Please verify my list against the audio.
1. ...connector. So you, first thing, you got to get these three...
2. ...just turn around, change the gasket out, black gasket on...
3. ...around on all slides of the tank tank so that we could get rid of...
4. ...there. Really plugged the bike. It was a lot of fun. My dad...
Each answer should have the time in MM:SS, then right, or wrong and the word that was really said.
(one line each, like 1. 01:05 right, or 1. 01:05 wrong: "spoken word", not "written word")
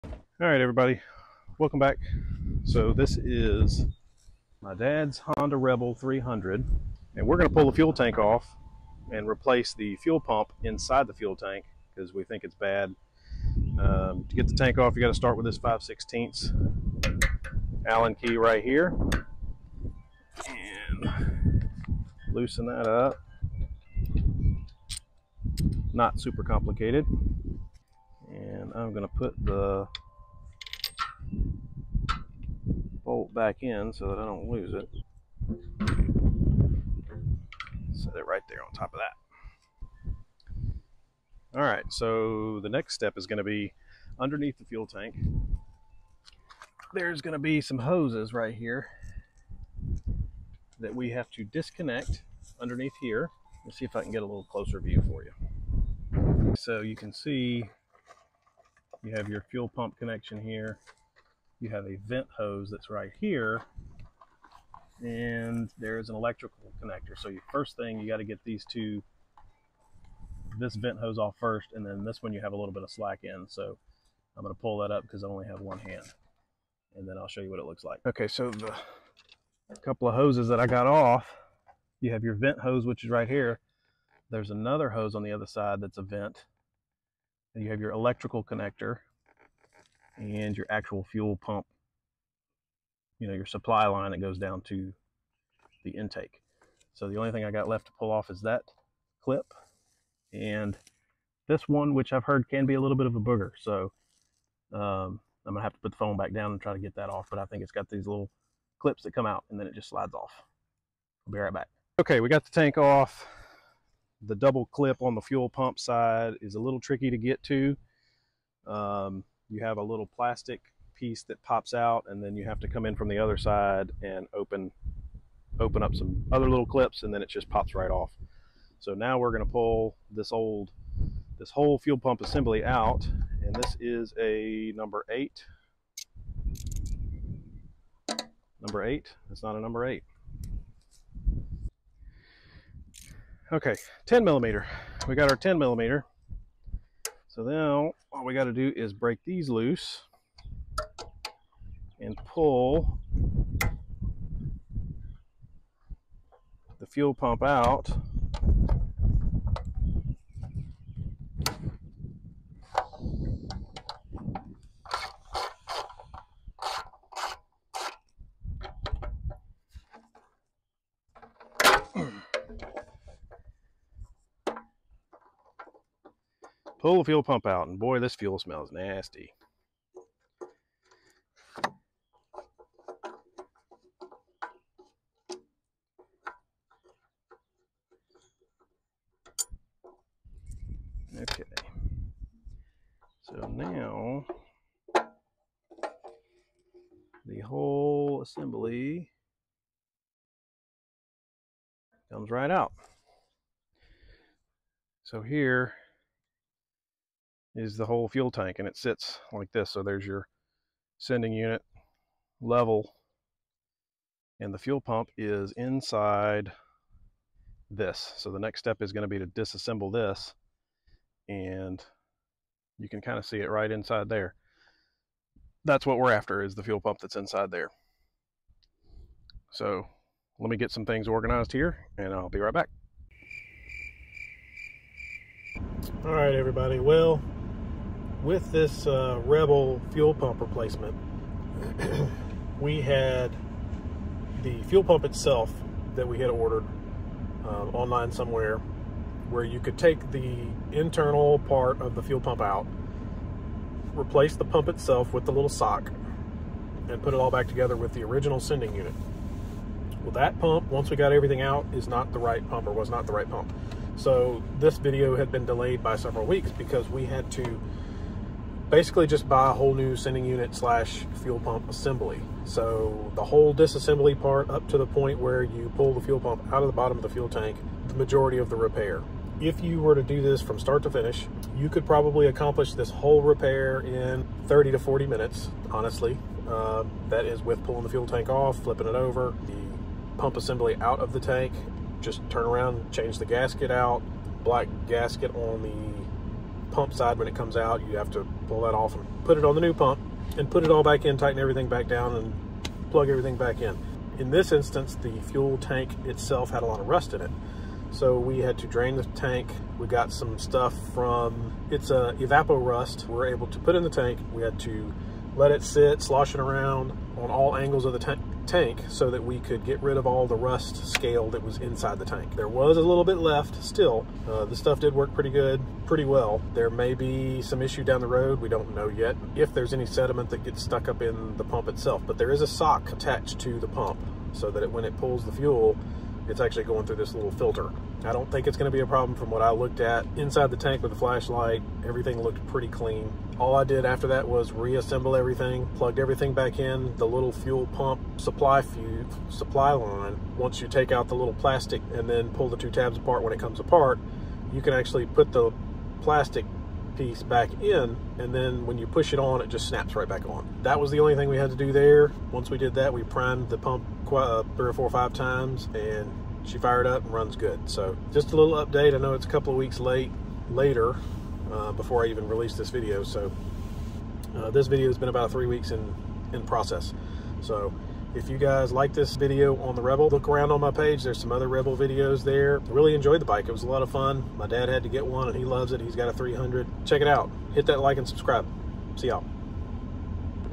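1. 01:06 wrong: "two", not "three"
2. 04:51 right
3. 05:16 wrong: "angles", not "slides"
4. 06:22 wrong: "enjoyed", not "plugged".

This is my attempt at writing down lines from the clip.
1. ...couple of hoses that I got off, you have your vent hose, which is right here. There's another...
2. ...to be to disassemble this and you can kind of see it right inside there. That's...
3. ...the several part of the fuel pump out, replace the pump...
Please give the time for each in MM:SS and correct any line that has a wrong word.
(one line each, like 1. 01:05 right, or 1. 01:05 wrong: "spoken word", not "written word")
1. 01:19 right
2. 03:39 right
3. 04:10 wrong: "internal", not "several".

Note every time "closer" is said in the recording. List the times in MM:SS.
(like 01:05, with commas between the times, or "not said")
00:54.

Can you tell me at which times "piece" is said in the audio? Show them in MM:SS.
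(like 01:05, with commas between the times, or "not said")
02:00, 05:56.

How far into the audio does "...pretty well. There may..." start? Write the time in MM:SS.
05:25.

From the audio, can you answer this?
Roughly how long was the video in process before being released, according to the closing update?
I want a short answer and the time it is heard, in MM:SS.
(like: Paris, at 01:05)
About three weeks, at 06:15.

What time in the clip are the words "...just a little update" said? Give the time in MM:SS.
06:08.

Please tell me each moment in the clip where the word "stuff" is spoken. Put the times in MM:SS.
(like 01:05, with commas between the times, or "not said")
05:10, 05:24.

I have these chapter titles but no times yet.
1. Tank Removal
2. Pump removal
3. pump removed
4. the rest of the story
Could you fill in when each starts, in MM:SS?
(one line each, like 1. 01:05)
1. 01:30
2. 02:10
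3. 03:52
4. 04:20.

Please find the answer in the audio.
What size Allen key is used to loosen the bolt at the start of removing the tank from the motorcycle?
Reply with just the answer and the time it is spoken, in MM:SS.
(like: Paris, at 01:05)
5/16, at 00:15.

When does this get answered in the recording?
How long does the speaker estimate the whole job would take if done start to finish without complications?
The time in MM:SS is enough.
04:44.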